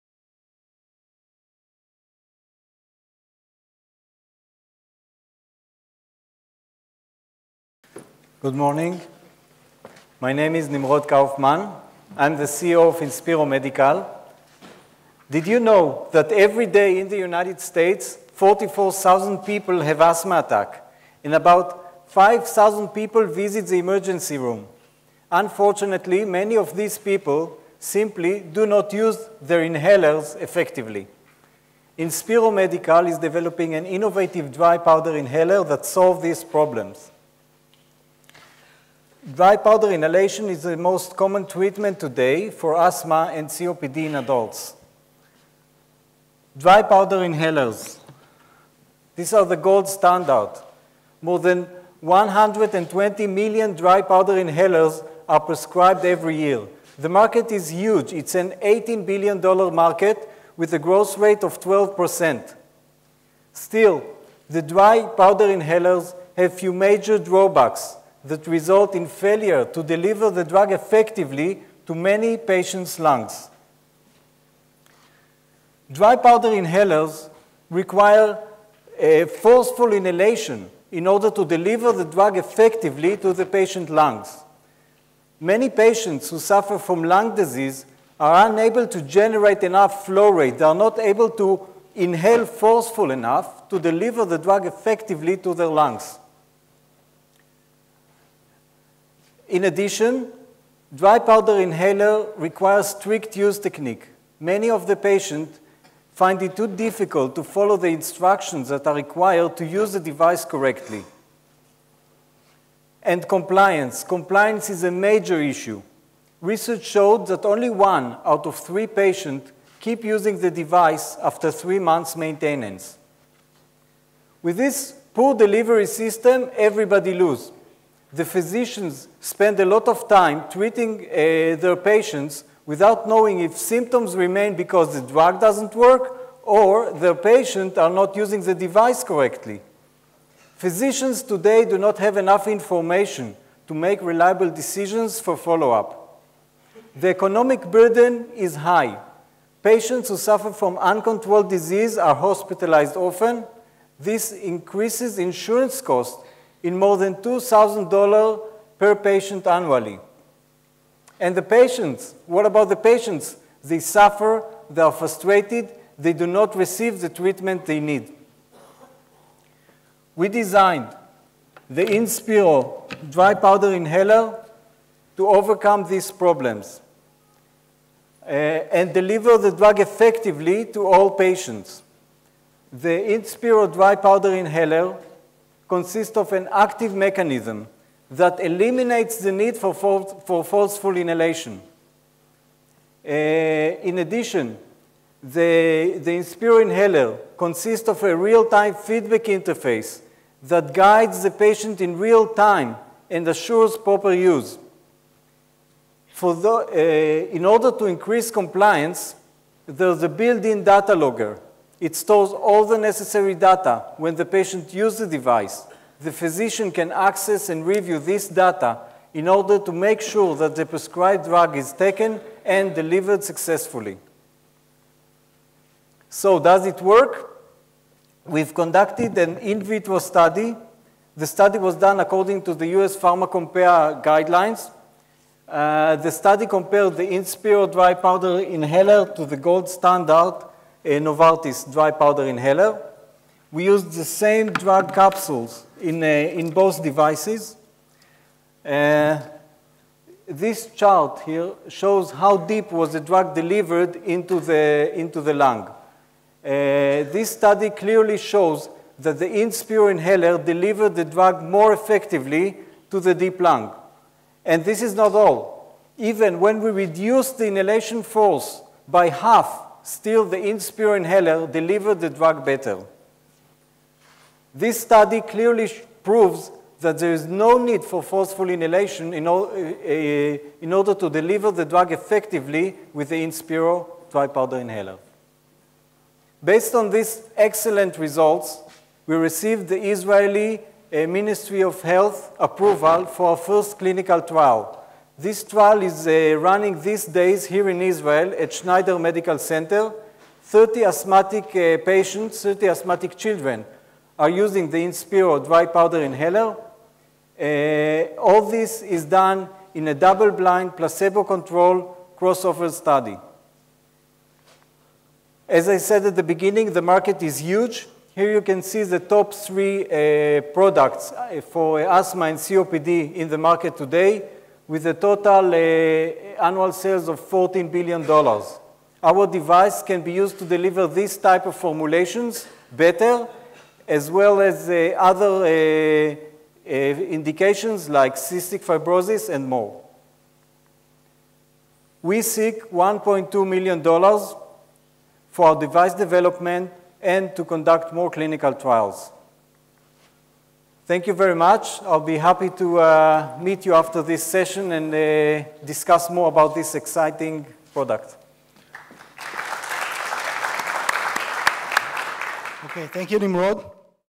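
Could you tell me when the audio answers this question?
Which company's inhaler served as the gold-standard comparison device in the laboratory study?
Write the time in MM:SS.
04:00.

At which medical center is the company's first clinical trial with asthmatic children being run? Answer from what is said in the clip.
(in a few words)
Schneider Medical Center.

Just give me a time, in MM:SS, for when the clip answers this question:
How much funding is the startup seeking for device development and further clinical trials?
05:42.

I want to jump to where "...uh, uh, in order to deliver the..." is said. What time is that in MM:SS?
04:39.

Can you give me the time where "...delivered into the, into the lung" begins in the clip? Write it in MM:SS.
04:13.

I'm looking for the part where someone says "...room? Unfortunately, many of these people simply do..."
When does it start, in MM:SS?
00:24.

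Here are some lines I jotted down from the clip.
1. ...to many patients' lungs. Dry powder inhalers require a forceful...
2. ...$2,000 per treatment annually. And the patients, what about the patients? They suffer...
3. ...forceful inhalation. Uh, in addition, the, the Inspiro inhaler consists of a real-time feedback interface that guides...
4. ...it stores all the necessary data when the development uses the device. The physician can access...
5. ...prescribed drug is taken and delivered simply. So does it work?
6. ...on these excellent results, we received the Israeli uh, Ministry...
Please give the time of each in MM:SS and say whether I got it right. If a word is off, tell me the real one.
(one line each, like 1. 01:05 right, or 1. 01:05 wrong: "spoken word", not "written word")
1. 01:11 right
2. 02:37 wrong: "patient", not "treatment"
3. 03:10 right
4. 03:31 wrong: "patient", not "development"
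5. 03:40 wrong: "successfully", not "simply"
6. 04:46 right.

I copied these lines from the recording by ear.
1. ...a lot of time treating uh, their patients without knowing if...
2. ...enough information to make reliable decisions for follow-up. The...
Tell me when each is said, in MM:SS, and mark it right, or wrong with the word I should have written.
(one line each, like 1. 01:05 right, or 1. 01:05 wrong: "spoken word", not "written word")
1. 02:09 right
2. 02:22 right.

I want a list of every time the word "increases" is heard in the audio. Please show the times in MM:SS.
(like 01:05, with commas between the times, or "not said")
02:34, 03:27.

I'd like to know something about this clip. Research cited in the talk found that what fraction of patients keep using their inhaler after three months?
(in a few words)
one out of three.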